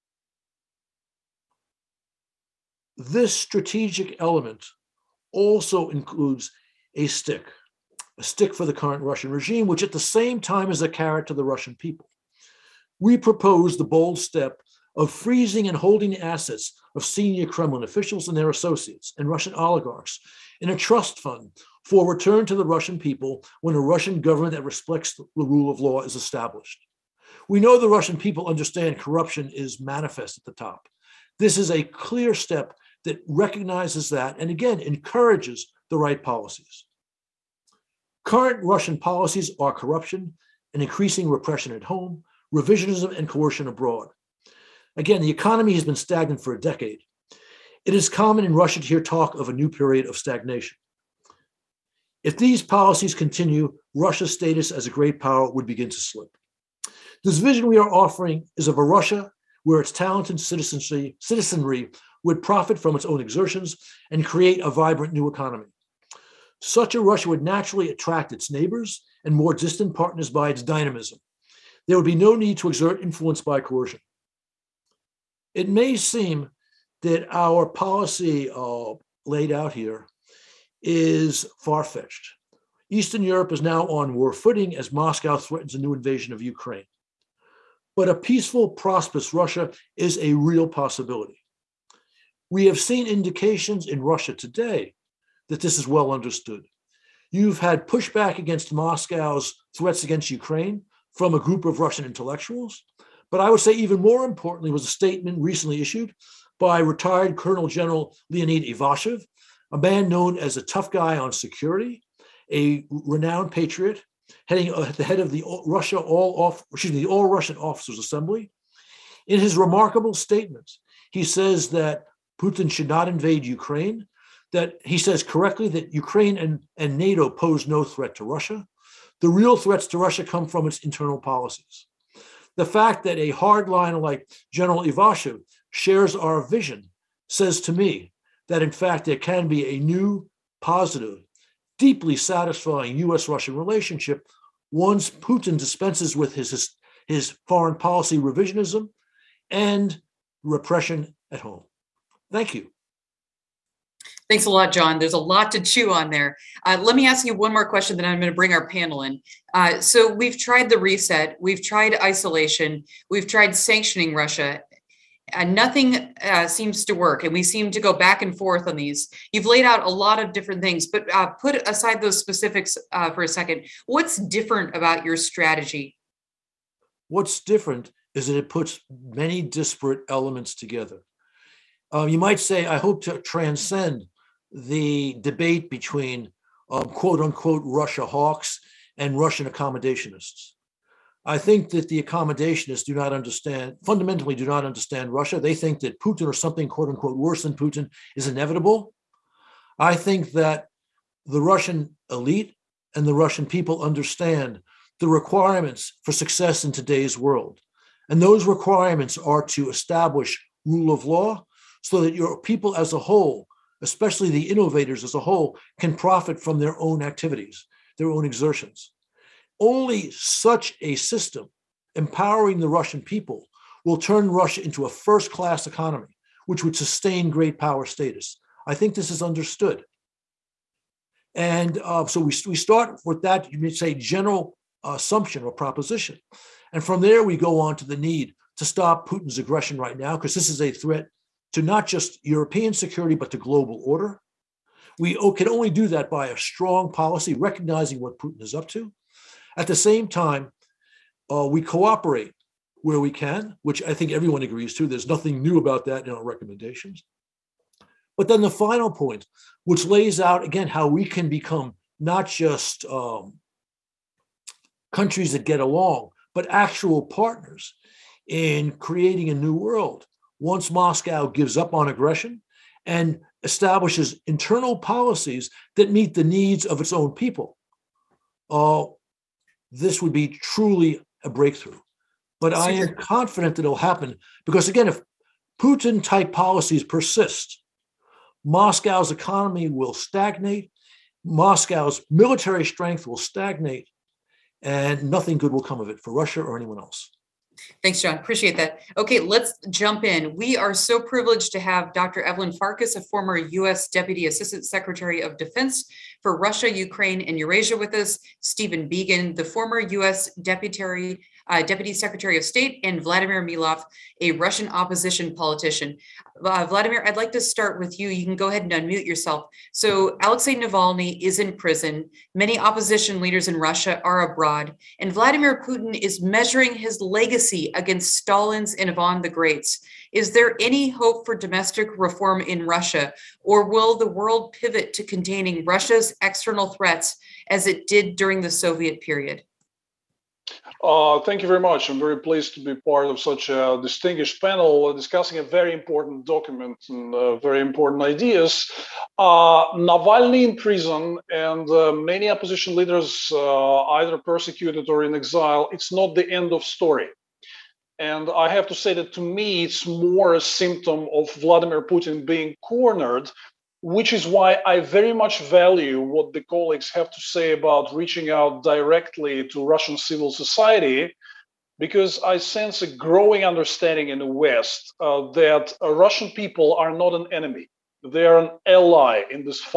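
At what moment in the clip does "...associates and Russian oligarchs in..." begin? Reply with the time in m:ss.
0:18.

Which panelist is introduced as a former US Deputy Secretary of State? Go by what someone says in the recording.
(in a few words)
Stephen Biegun.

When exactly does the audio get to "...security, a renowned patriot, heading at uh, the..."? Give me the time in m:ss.
1:51.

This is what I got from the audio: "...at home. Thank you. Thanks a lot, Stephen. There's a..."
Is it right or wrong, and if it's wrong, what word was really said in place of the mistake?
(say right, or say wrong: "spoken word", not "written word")
wrong: "John", not "Stephen".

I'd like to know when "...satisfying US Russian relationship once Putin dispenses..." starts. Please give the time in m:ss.
2:22.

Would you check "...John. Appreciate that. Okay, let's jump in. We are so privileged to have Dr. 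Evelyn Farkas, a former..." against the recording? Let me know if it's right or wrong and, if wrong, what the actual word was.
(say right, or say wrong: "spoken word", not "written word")
right.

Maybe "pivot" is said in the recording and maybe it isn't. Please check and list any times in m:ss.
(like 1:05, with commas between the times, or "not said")
5:34.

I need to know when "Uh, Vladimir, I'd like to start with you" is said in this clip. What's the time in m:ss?
5:16.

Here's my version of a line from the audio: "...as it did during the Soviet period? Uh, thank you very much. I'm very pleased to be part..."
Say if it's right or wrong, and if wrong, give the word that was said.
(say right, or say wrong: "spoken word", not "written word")
right.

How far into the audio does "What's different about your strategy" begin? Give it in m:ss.
2:53.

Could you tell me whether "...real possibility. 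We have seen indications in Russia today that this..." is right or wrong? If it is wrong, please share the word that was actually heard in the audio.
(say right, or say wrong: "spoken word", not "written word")
right.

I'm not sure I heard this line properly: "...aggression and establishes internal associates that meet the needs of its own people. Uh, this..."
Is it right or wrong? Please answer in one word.
wrong.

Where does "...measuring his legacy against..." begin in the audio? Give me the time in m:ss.
5:26.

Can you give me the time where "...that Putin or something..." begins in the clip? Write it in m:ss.
3:15.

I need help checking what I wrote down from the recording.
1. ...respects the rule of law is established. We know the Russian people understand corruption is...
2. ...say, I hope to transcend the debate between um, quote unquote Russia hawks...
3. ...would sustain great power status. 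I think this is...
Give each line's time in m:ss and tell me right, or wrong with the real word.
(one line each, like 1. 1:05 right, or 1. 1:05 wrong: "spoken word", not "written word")
1. 0:24 right
2. 3:02 right
3. 3:46 right.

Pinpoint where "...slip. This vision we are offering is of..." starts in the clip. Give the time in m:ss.
0:55.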